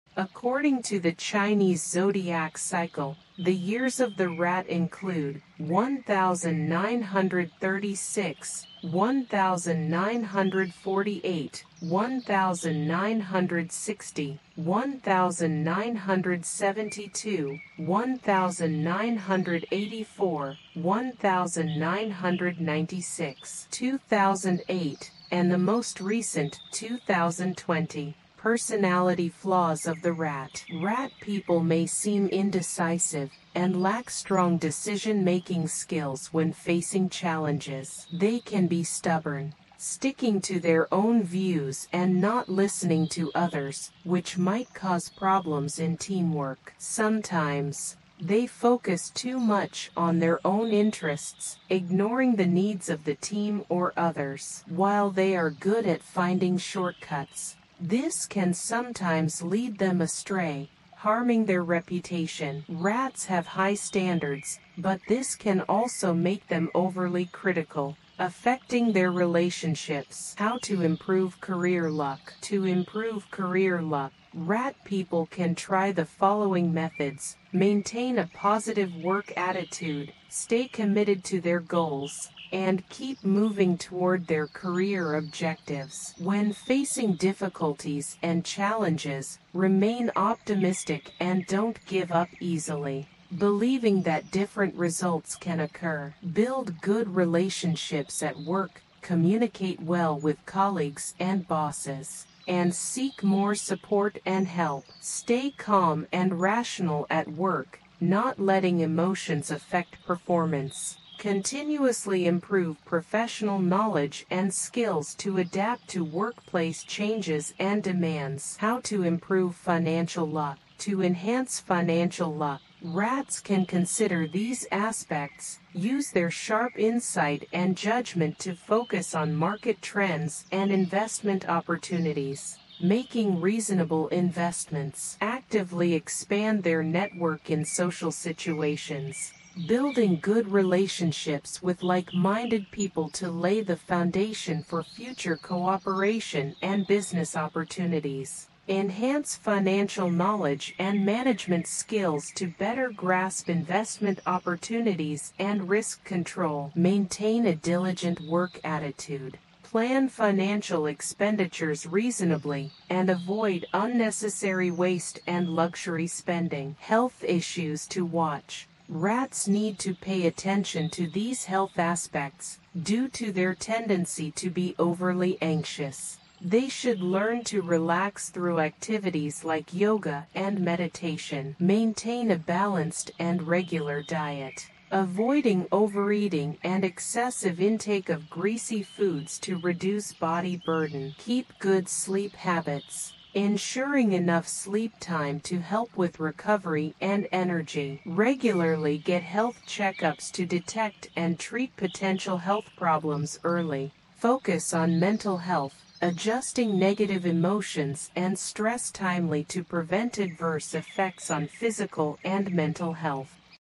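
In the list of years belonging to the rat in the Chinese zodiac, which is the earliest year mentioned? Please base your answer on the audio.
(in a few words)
1936.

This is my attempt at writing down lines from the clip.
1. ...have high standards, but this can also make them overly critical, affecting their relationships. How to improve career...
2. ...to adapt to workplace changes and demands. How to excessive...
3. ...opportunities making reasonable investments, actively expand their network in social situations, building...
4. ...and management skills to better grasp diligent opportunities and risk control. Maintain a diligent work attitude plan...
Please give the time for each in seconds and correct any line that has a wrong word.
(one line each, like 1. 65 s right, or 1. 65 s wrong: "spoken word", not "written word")
1. 63 s right
2. 115 s wrong: "improve", not "excessive"
3. 131 s right
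4. 150 s wrong: "investment", not "diligent".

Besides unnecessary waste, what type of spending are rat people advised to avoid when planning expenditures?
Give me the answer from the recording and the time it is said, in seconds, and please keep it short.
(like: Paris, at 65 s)
luxury spending, at 165 s.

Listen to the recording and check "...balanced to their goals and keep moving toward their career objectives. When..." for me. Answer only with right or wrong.
wrong.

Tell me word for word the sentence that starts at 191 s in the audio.
Keep good sleep habits ensuring enough sleep time to help with recovery and energy.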